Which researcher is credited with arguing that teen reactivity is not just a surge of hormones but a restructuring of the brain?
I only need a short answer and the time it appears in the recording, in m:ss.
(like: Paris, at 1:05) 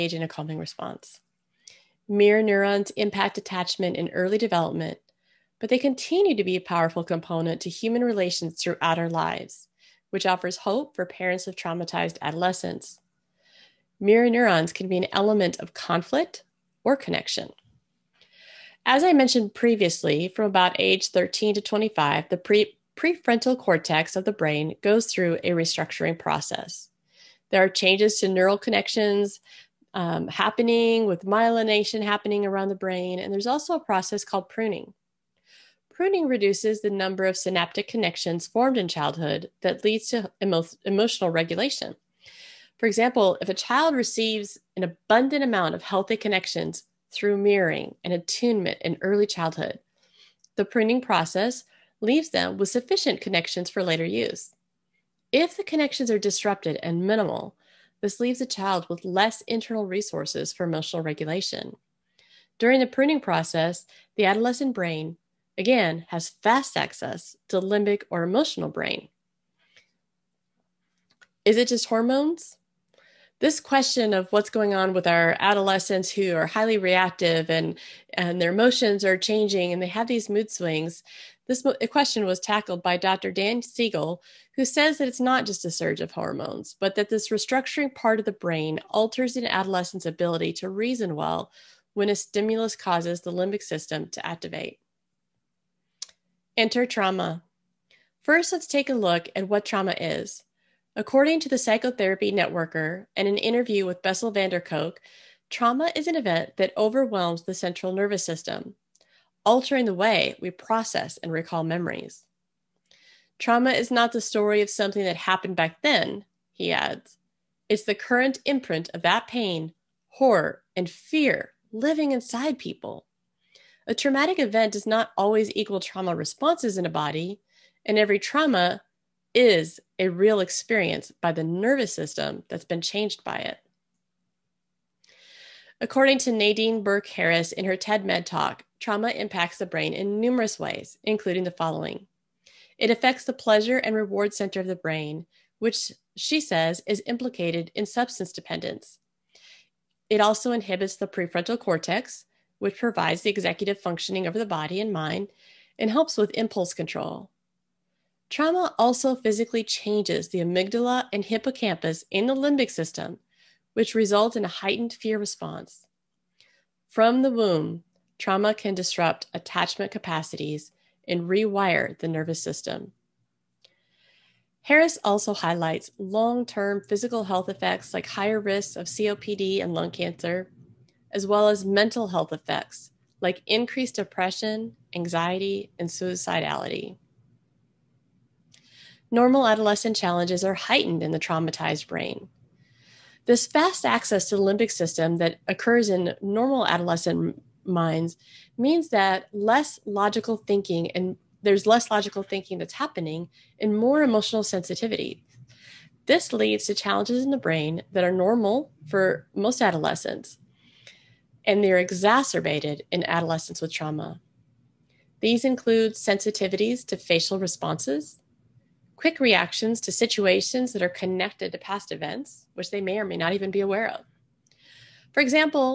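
Dr. Dan Siegel, at 1:22.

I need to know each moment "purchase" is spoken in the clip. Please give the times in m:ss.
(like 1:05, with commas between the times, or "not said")
not said.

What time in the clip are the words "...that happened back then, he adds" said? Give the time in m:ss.
1:55.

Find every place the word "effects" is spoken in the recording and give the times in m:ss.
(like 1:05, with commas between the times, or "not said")
2:57, 3:02.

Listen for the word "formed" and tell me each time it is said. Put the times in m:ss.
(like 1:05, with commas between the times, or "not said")
0:38.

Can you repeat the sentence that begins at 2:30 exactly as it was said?
It also inhibits the prefrontal cortex, which provides the executive functioning over the body and mind and helps with impulse control.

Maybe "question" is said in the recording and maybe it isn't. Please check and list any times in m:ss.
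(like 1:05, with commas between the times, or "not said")
1:13, 1:21.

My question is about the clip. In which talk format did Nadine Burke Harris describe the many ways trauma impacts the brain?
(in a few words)
TED Med talk.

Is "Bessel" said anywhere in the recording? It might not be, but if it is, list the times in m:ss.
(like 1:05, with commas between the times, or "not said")
1:44.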